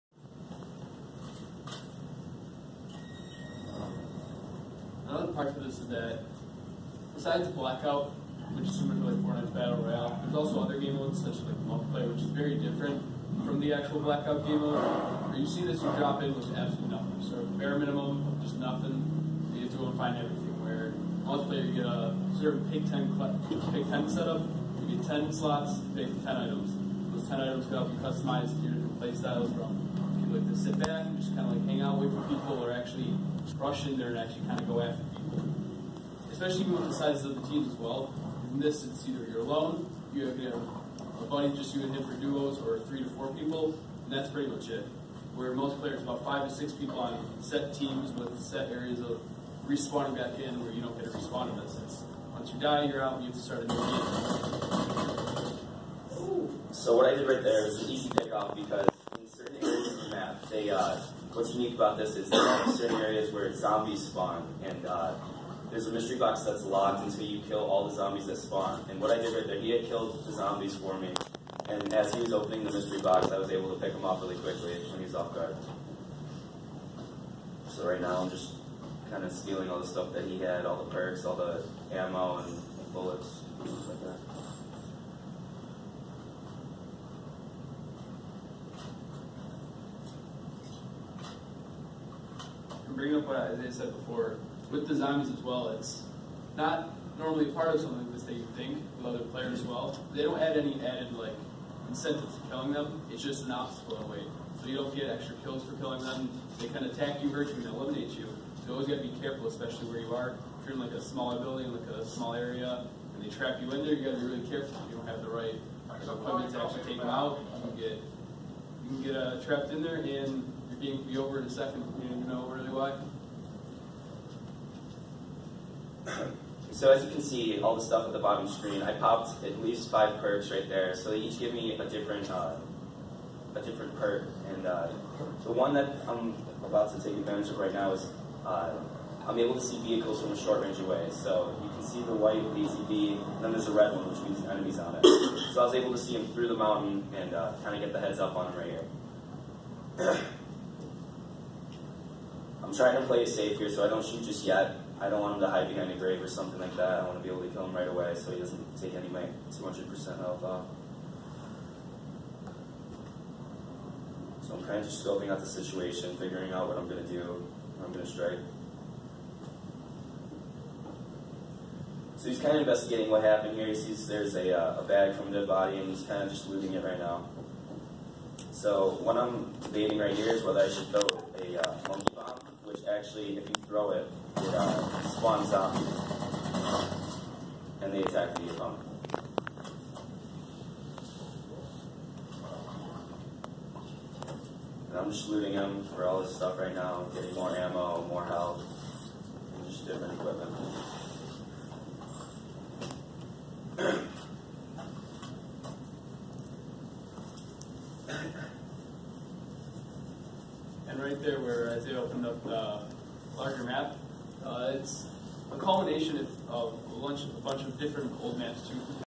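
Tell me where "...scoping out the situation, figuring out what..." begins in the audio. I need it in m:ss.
2:45.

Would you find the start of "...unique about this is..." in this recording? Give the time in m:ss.
1:01.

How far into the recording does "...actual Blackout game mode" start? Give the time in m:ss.
0:13.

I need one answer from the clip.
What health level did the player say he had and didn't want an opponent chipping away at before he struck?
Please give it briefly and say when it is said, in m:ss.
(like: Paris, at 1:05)
200%, at 2:39.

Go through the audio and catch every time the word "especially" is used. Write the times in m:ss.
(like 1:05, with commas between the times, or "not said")
0:36, 1:49.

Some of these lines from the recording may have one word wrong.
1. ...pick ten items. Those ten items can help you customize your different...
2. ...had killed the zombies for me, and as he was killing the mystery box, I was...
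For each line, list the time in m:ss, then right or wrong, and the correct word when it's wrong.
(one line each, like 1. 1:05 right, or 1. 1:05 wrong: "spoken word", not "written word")
1. 0:25 right
2. 1:09 wrong: "opening", not "killing".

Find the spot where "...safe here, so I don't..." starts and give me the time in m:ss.
2:33.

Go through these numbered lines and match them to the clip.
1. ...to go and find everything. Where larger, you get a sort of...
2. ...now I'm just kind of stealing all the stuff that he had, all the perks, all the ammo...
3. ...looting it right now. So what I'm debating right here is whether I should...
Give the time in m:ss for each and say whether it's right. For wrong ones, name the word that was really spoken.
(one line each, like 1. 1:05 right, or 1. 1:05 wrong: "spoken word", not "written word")
1. 0:19 wrong: "multiplayer", not "larger"
2. 1:18 right
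3. 2:56 right.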